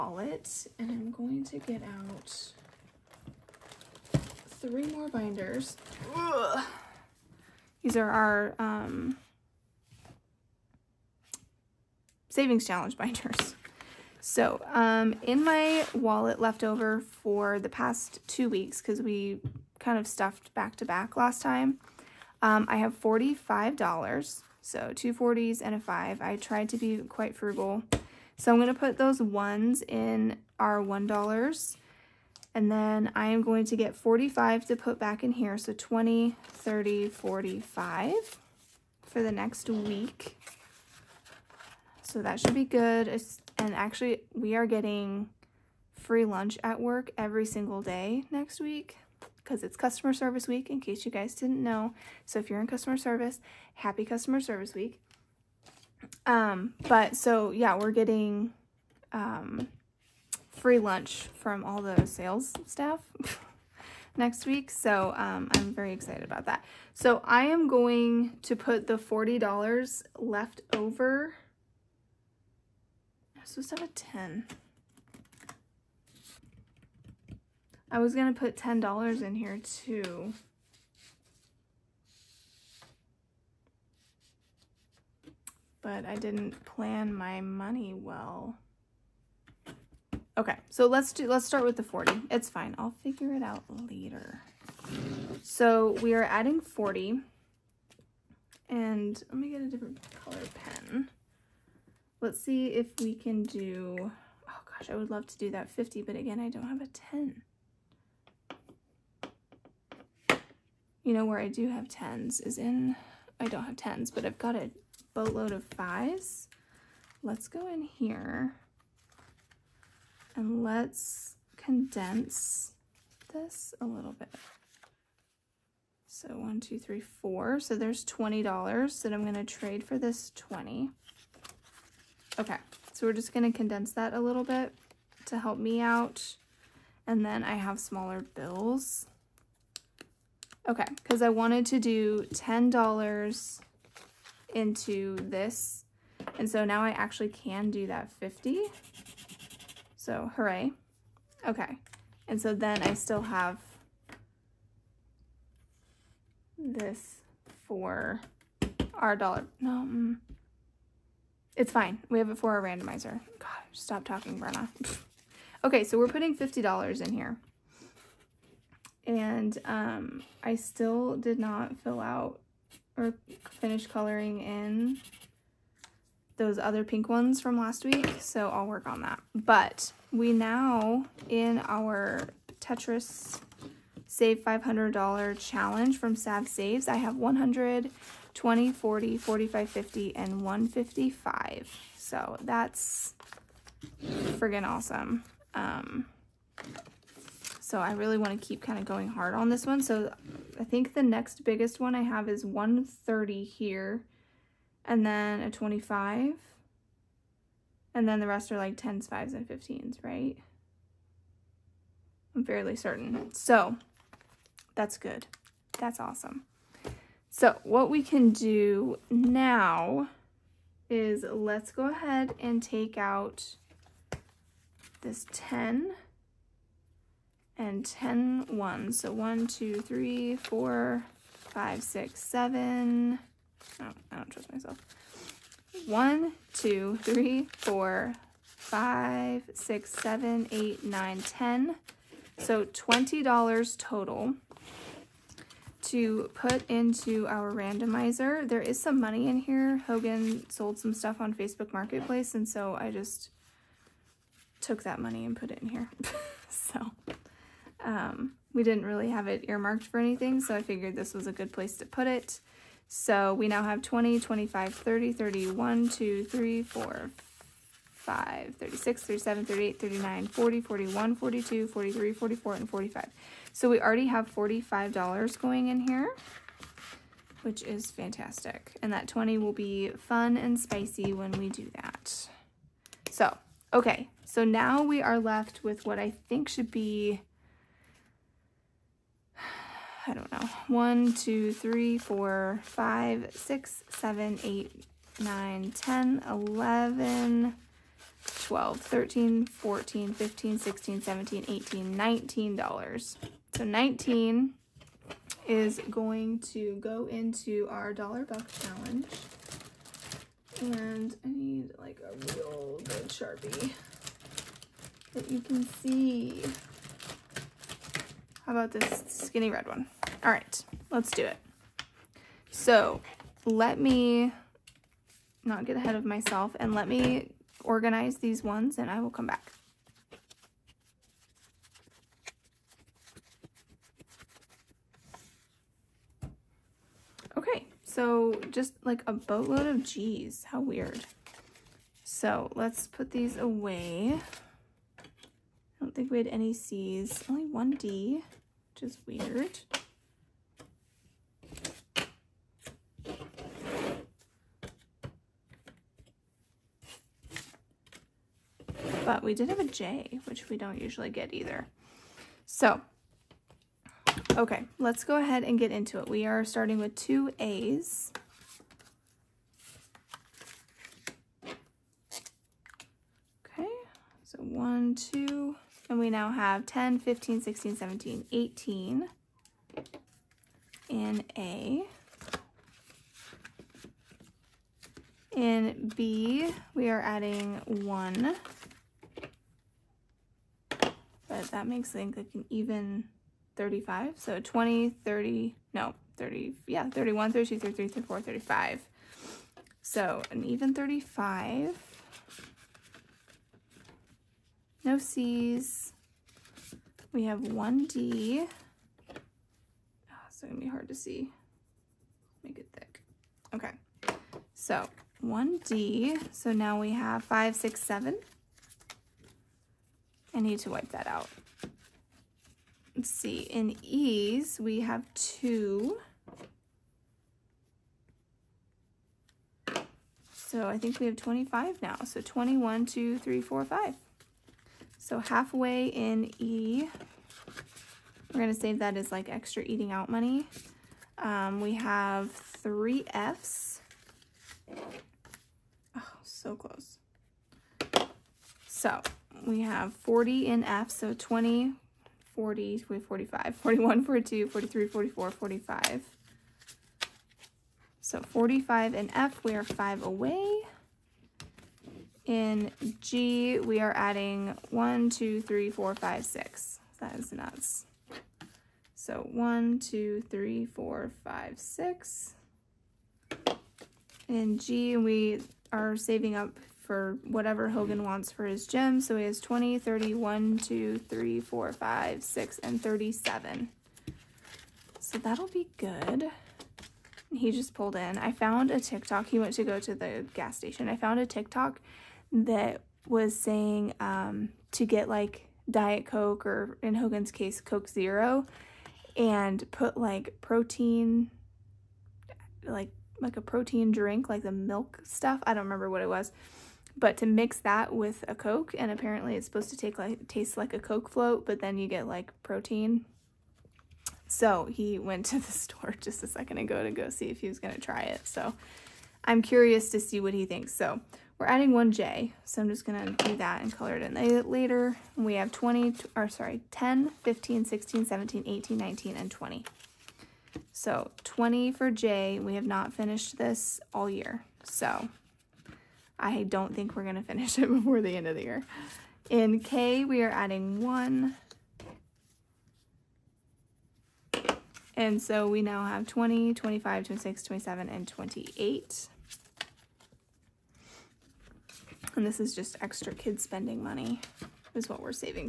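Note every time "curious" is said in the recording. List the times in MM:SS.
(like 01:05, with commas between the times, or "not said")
08:39.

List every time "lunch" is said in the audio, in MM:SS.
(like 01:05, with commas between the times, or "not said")
00:46, 01:00.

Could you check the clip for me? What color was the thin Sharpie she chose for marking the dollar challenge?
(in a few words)
Red.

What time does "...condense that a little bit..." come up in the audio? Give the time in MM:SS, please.
02:13.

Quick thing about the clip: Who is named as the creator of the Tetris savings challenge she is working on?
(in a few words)
Sav Saves.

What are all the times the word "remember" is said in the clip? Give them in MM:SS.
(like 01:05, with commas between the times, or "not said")
08:25.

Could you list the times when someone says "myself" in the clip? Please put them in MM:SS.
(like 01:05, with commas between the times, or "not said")
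03:54, 05:26.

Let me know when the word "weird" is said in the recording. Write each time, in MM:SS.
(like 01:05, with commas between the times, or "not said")
05:40, 05:49.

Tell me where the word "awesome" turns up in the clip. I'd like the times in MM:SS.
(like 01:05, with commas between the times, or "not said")
03:14, 03:35.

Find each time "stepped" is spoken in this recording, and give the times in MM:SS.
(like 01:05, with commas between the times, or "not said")
not said.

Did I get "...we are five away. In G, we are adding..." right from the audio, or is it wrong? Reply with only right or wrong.
right.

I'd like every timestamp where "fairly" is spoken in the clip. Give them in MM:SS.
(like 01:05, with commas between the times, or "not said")
03:32.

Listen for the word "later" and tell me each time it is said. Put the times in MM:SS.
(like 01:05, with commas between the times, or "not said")
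01:33, 08:44.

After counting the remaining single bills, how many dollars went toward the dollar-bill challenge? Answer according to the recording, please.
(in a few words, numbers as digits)
$19.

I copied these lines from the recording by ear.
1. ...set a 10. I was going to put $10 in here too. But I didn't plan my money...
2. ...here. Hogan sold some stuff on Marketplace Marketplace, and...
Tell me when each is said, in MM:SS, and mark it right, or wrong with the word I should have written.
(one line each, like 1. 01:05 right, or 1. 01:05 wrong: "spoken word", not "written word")
1. 01:13 right
2. 04:09 wrong: "Facebook", not "Marketplace".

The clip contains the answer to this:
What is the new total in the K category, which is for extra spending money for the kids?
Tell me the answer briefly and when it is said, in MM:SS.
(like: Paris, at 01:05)
28, at 09:08.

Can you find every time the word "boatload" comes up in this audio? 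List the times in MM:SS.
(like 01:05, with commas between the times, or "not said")
01:55, 05:39.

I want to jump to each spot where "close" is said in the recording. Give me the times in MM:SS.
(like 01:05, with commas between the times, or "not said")
07:26.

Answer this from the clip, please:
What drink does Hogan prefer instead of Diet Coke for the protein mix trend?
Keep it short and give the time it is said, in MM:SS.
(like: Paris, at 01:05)
Coke Zero, at 08:17.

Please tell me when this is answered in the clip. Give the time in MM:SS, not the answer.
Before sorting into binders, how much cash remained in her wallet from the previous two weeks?
00:22.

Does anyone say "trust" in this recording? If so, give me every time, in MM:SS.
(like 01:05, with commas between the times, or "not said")
03:54.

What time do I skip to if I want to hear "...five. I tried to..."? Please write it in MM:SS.
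00:25.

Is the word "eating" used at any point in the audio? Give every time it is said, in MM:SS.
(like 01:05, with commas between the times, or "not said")
07:19.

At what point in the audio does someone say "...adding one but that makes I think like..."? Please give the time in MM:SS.
06:27.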